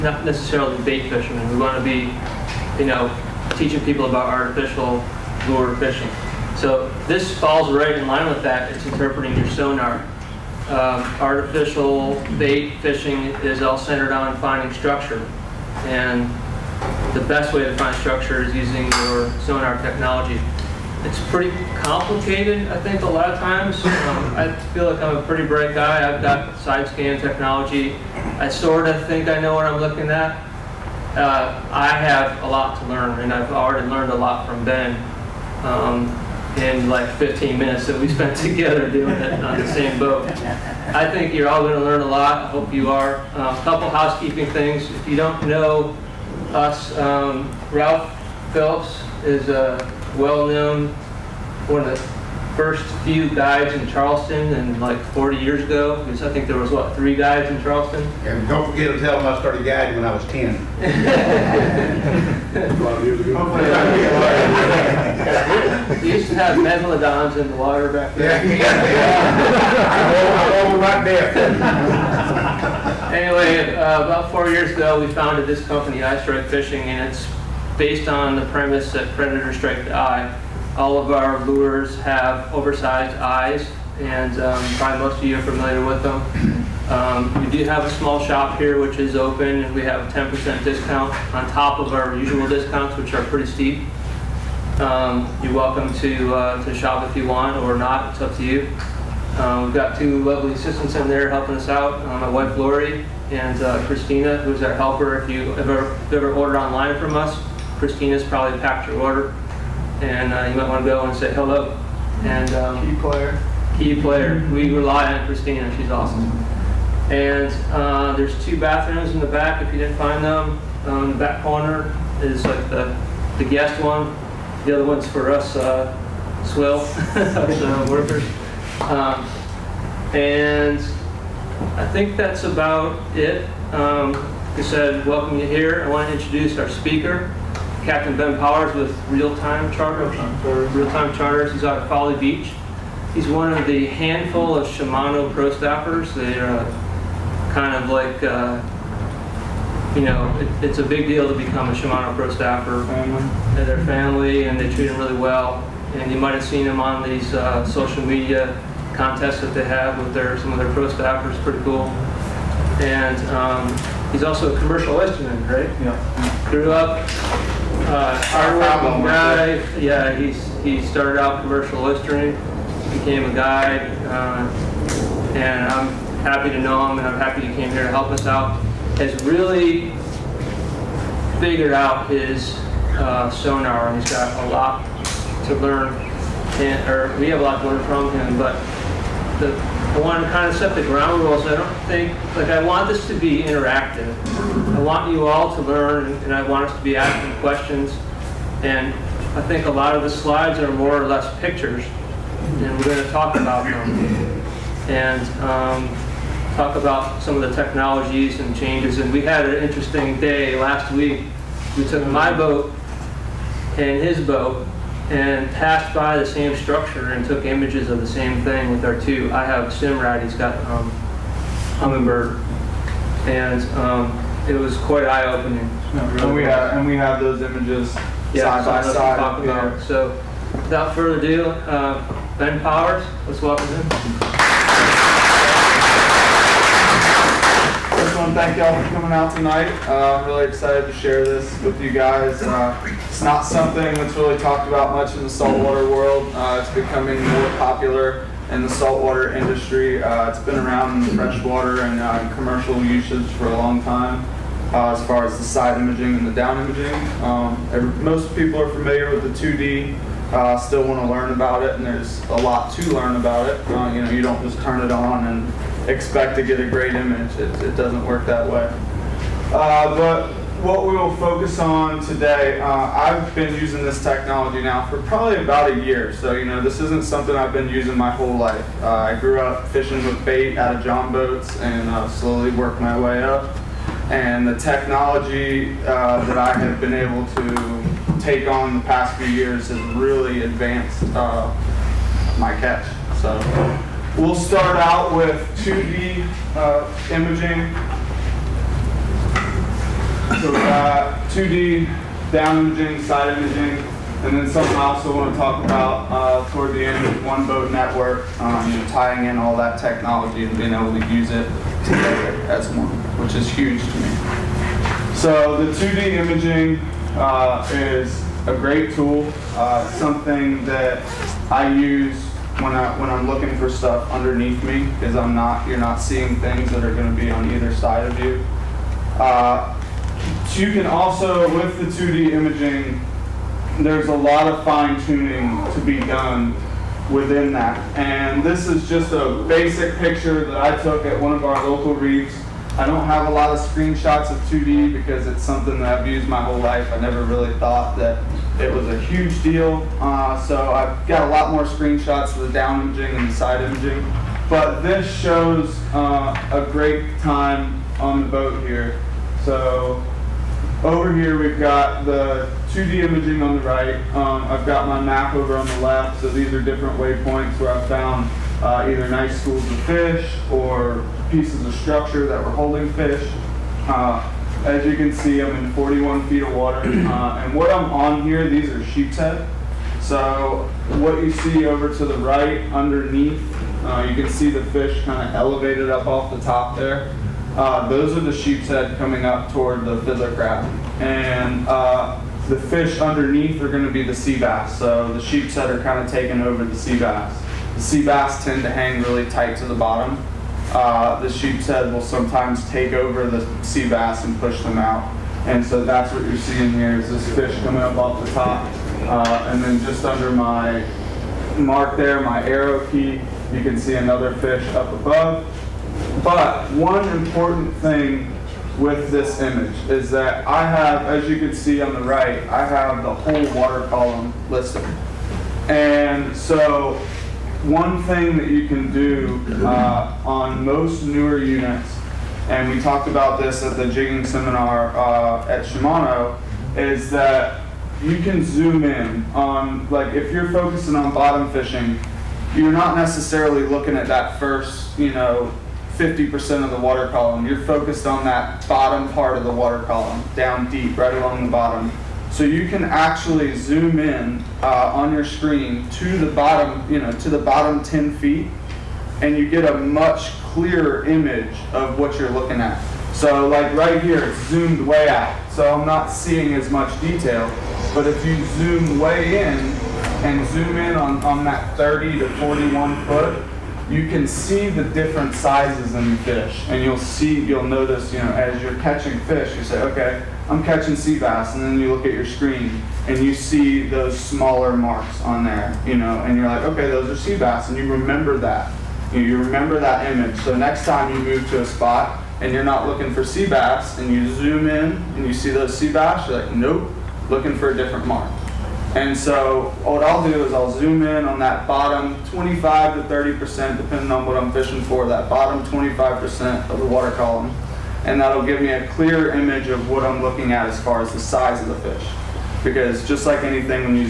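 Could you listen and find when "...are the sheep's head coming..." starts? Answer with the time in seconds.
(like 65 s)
388 s.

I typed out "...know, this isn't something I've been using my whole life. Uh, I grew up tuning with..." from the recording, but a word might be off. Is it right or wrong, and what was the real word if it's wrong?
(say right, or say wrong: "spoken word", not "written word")
wrong: "fishing", not "tuning".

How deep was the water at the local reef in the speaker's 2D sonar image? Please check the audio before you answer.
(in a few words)
41 feet.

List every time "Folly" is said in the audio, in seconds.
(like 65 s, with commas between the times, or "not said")
141 s.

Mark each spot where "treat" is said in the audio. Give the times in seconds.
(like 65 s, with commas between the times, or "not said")
154 s.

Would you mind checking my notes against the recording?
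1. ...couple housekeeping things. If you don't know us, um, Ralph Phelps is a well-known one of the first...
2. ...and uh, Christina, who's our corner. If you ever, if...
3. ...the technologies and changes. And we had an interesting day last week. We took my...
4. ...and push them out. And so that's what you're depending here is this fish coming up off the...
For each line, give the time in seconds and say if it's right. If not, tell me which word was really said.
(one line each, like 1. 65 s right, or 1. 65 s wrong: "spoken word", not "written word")
1. 43 s right
2. 103 s wrong: "helper", not "corner"
3. 207 s right
4. 404 s wrong: "seeing", not "depending".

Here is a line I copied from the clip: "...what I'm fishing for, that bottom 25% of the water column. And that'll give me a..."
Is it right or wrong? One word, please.
right.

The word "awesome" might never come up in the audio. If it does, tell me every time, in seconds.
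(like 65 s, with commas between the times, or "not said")
115 s.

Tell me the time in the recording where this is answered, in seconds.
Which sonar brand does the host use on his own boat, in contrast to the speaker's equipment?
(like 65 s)
219 s.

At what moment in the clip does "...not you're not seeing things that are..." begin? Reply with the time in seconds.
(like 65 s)
325 s.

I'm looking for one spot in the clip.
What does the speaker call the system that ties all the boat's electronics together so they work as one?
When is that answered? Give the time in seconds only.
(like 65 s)
307 s.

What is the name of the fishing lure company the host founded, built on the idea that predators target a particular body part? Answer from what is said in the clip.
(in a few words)
Eye Strike Fishing.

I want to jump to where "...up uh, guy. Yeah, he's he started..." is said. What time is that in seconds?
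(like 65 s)
166 s.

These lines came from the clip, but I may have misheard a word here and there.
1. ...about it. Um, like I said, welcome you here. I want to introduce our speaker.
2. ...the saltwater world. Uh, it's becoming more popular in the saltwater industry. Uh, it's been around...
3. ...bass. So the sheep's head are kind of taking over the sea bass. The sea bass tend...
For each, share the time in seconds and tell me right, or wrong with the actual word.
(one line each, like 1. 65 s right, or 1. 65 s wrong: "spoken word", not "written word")
1. 132 s right
2. 245 s right
3. 394 s right.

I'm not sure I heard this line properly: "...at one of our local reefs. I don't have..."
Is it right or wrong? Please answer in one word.
right.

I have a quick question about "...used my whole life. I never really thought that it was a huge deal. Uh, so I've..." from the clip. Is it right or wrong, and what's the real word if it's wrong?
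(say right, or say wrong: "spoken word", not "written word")
right.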